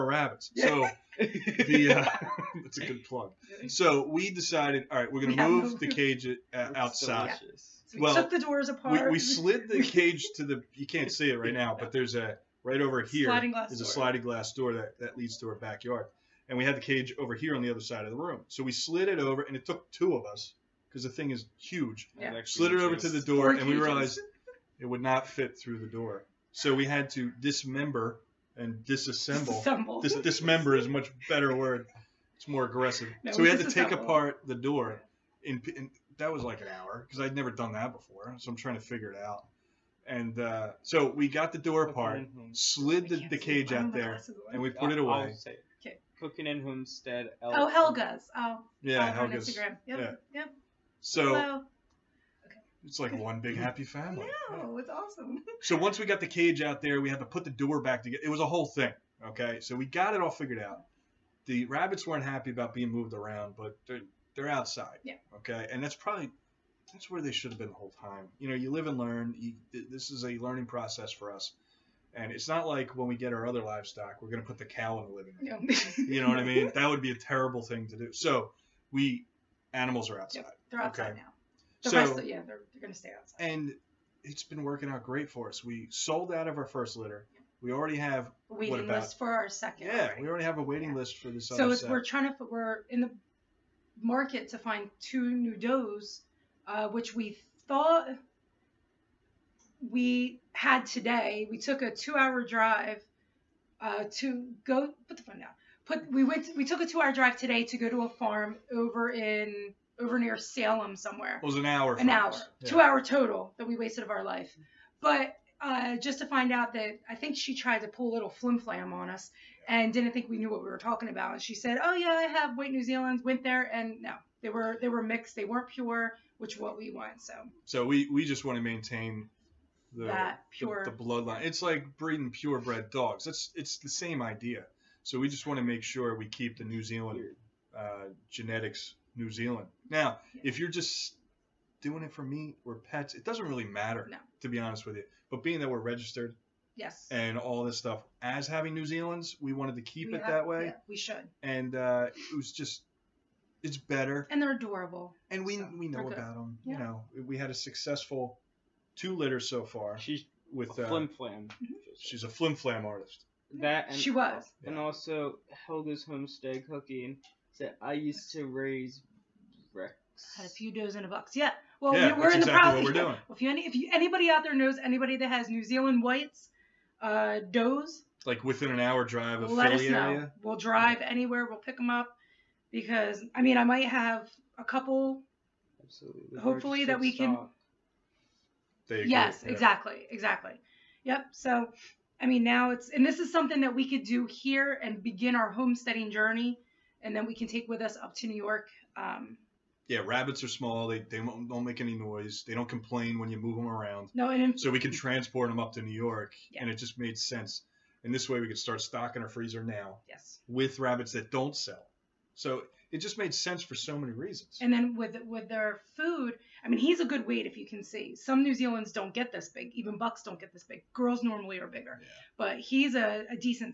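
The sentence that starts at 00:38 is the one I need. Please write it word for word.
So I'm trying to figure it out.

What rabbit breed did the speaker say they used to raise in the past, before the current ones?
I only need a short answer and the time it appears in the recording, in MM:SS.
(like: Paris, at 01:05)
Rex, at 02:49.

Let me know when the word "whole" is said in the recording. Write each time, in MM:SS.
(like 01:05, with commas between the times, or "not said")
00:58, 01:07.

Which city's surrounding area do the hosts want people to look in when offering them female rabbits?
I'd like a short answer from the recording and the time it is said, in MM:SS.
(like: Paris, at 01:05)
Philly, at 02:59.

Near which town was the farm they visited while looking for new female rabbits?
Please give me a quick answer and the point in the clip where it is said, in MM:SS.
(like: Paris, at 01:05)
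Salem, at 01:50.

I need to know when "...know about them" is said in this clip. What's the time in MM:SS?
02:35.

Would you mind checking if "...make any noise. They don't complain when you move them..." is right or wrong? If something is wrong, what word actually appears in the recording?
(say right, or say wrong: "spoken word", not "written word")
right.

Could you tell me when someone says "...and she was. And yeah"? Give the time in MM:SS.
02:43.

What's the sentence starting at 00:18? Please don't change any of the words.
So we slid it over, and it took two of us because the thing is huge.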